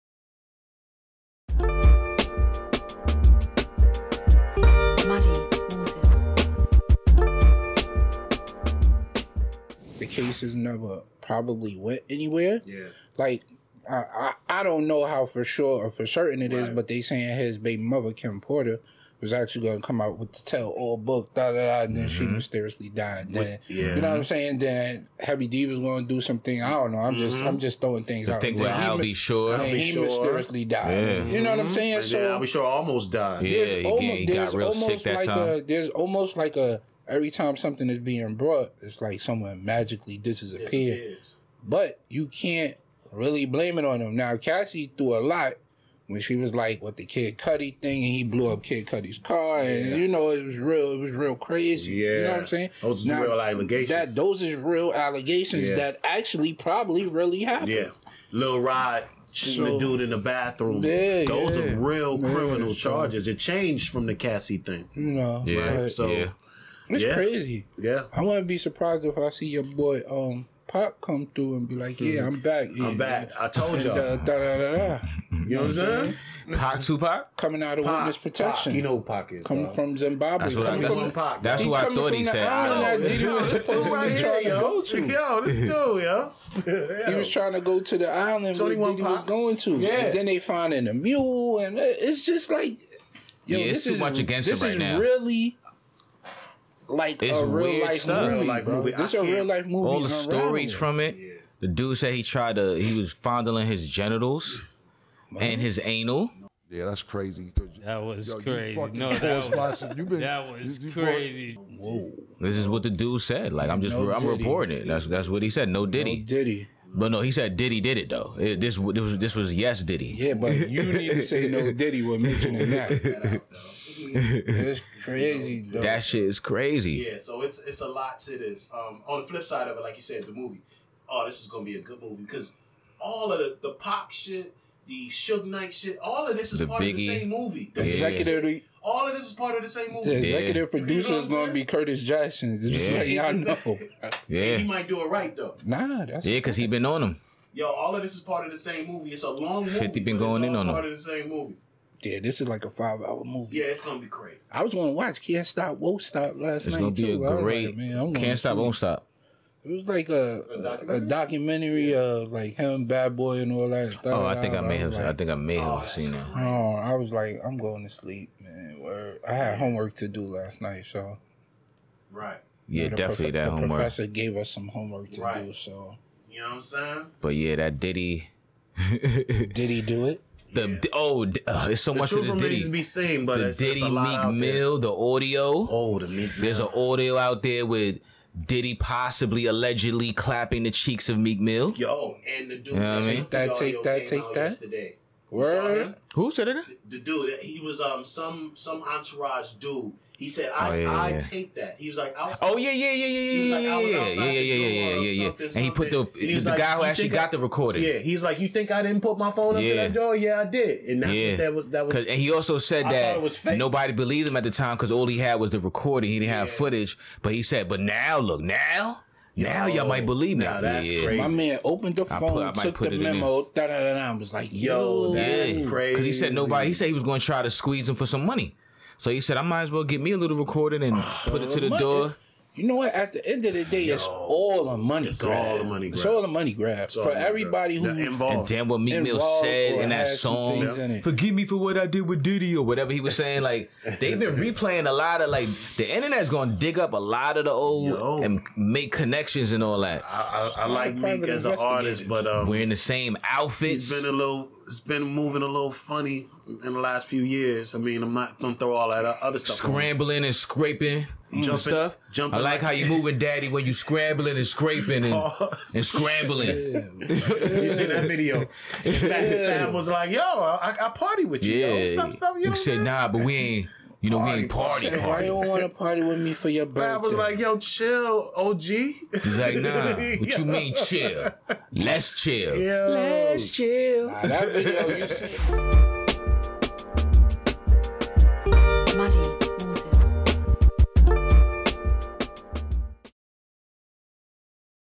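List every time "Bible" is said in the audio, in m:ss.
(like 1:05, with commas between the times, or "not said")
not said.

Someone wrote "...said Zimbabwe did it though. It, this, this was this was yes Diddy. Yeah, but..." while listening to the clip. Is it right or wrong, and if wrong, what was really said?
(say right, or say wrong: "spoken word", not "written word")
wrong: "Diddy", not "Zimbabwe".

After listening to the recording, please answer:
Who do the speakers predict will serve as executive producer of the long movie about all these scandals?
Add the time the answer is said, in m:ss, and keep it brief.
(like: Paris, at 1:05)
Curtis Jackson, at 2:21.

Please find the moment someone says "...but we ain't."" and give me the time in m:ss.
4:33.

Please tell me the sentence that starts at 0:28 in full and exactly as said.
Thing with Albie will be he sure.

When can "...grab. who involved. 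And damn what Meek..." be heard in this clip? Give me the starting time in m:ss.
3:57.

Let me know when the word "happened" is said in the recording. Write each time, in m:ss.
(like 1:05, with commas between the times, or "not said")
0:57.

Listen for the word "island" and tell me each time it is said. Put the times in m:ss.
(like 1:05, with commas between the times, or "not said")
1:22, 1:28.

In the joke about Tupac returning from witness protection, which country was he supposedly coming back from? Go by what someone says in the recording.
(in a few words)
Zimbabwe.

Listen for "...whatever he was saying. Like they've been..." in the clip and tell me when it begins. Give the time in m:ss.
4:02.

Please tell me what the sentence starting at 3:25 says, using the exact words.
And he put the he the, the like, guy who actually got the recording.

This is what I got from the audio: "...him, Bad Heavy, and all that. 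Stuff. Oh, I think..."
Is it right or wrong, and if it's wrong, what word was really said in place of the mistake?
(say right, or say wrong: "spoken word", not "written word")
wrong: "Boy", not "Heavy".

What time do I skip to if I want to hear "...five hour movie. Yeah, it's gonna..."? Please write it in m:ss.
2:32.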